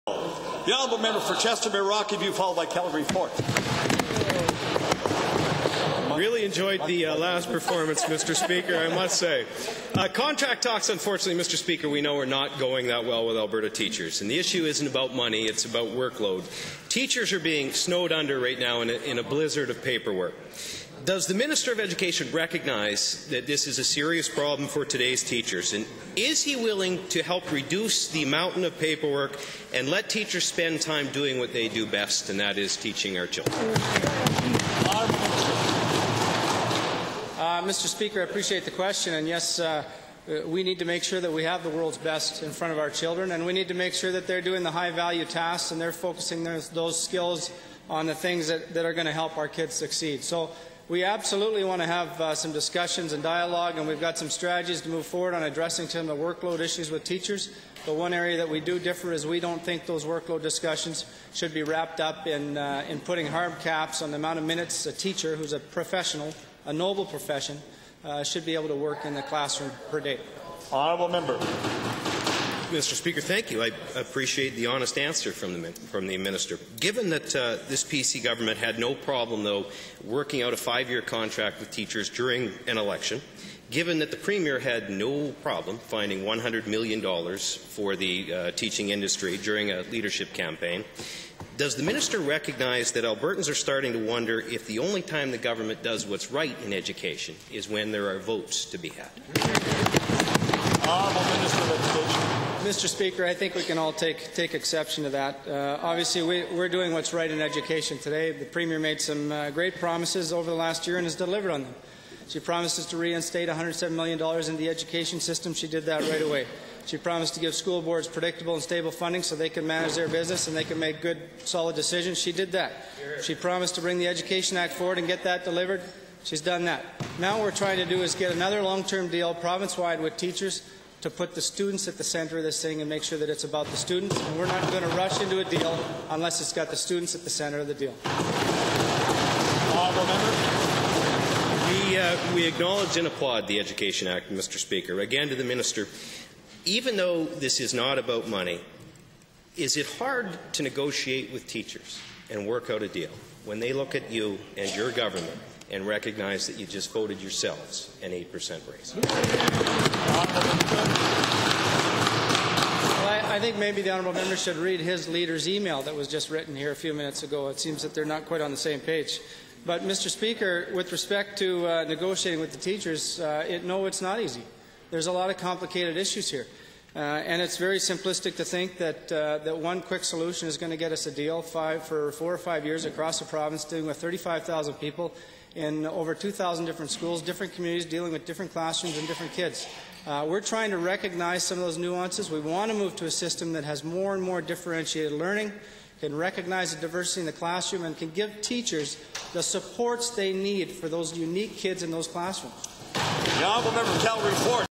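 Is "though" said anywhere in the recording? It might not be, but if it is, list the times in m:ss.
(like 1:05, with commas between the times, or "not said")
1:19, 2:26.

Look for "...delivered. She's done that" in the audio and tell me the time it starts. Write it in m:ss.
2:05.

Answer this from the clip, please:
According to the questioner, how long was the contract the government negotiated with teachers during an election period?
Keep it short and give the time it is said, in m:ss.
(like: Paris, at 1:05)
5 years, at 1:20.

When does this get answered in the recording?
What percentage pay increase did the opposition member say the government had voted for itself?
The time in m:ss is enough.
2:38.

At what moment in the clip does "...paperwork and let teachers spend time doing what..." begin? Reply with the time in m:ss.
0:28.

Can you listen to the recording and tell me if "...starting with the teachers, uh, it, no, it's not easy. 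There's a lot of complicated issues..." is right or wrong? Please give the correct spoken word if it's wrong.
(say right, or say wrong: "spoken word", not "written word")
wrong: "negotiating", not "starting".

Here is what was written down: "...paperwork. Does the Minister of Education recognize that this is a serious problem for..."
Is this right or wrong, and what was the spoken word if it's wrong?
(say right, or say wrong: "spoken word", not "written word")
right.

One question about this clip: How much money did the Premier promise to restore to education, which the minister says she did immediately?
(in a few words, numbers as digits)
$107 million.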